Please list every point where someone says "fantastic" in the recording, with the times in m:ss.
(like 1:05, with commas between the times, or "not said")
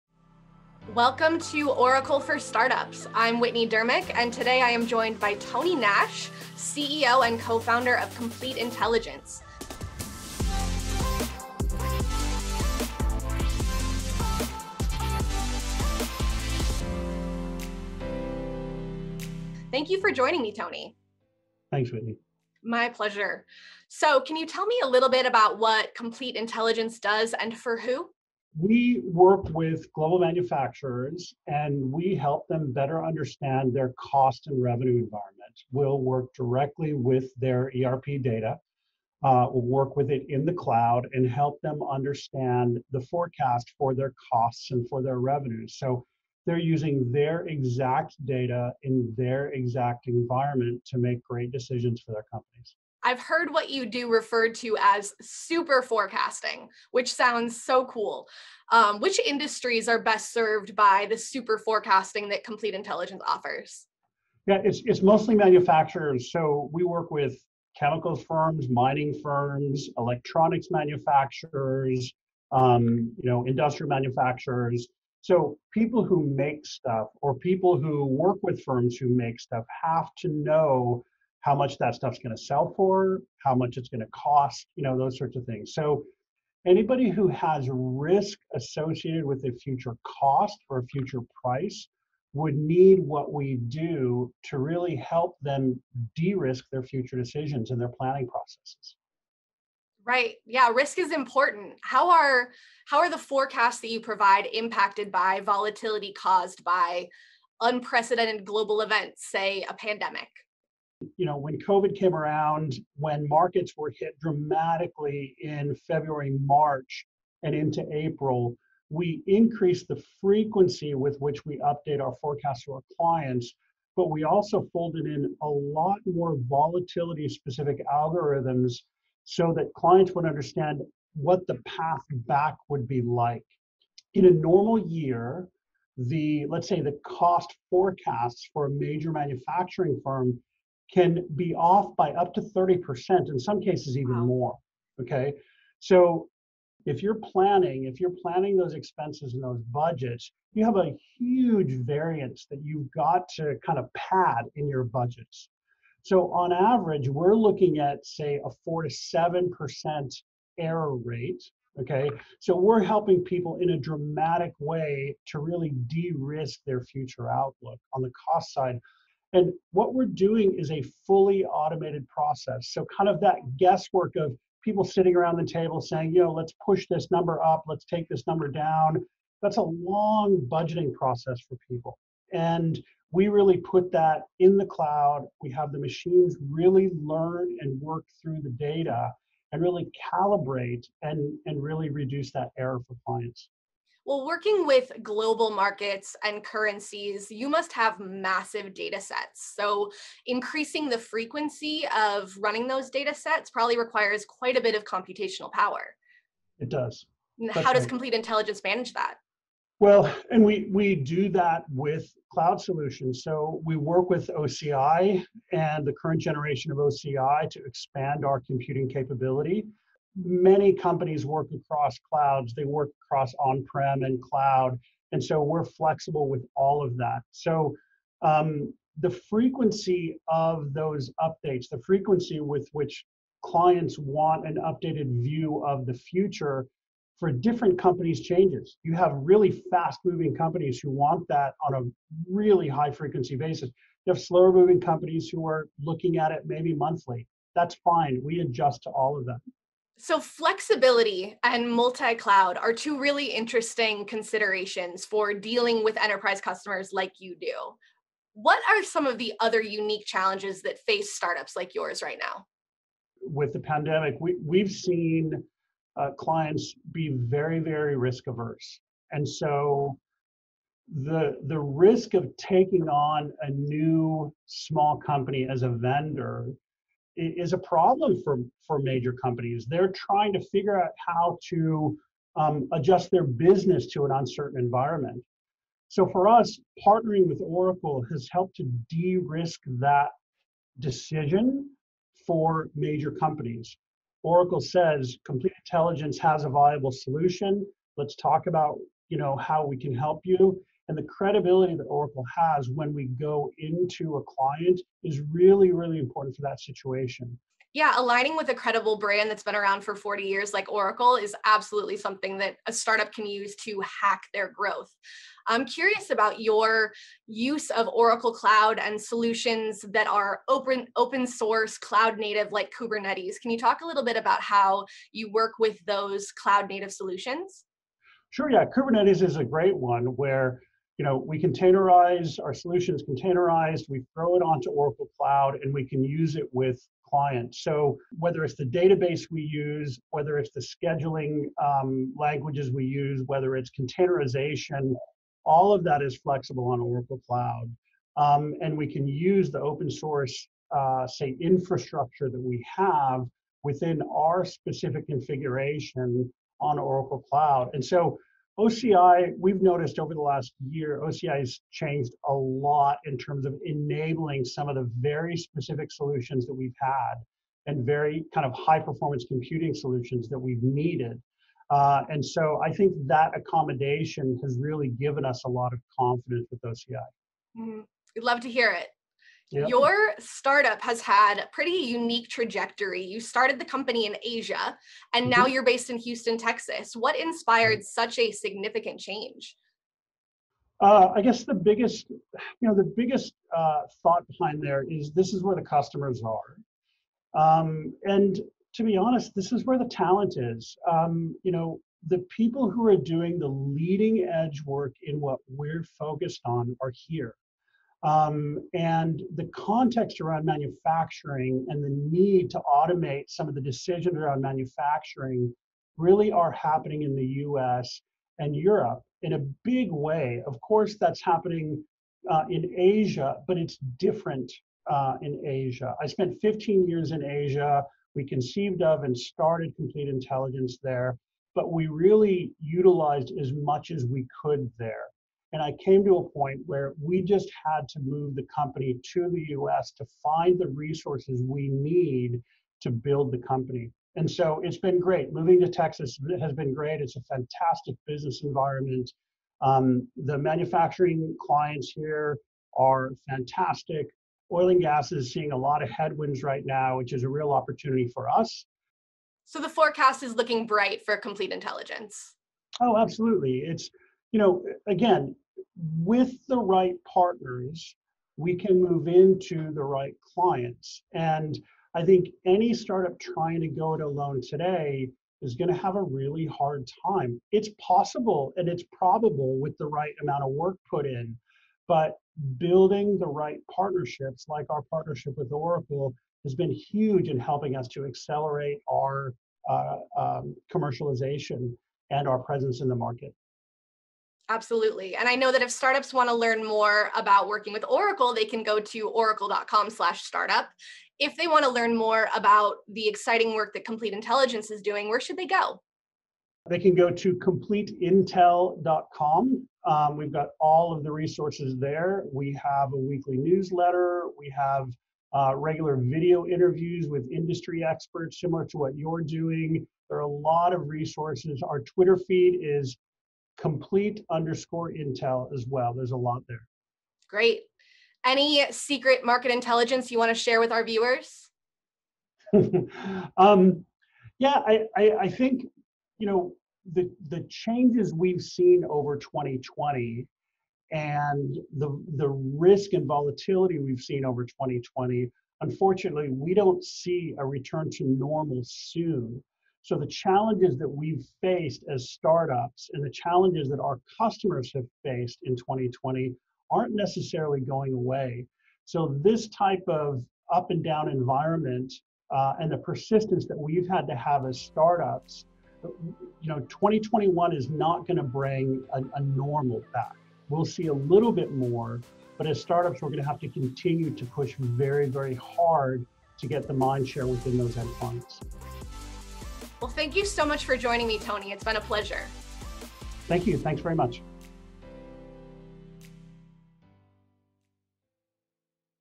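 7:27, 7:33.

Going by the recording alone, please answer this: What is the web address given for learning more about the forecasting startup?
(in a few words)
completeintel.com.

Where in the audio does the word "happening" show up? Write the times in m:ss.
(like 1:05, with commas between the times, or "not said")
6:56, 7:01.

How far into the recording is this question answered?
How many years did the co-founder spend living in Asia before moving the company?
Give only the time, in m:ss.
7:06.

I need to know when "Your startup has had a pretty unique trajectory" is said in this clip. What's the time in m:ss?
6:19.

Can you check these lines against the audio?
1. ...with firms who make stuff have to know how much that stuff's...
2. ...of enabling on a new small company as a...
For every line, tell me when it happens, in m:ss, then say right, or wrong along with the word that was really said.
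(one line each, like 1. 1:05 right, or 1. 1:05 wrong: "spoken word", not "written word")
1. 1:18 right
2. 4:32 wrong: "taking", not "enabling".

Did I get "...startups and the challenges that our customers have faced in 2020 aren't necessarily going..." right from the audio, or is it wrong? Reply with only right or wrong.
right.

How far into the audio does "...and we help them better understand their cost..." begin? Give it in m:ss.
0:31.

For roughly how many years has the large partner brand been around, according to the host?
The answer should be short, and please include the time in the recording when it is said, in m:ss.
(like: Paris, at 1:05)
40, at 5:09.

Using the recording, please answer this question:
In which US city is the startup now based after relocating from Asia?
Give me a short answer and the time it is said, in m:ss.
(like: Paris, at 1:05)
Houston, at 6:25.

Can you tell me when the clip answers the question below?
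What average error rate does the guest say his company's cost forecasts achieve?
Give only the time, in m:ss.
2:38.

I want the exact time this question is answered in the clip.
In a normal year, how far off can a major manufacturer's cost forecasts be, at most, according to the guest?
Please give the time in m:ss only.
2:22.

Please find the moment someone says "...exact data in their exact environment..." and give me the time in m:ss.
0:47.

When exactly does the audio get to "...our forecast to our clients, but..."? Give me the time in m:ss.
2:02.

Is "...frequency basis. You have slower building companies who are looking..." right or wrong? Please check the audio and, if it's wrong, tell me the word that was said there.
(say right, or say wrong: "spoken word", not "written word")
wrong: "moving", not "building".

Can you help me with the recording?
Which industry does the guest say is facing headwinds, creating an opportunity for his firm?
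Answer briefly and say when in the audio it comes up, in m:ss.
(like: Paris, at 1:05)
Oil and gas, at 7:34.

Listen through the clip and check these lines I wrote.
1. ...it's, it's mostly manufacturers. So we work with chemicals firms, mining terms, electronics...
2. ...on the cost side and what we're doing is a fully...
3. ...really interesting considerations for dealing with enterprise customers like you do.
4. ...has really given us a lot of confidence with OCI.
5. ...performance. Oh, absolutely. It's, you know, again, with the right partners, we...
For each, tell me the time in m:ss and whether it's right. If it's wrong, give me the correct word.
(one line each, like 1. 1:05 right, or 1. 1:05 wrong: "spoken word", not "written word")
1. 1:04 wrong: "firms", not "terms"
2. 2:47 right
3. 4:12 right
4. 6:14 right
5. 7:41 wrong: "intelligence", not "performance".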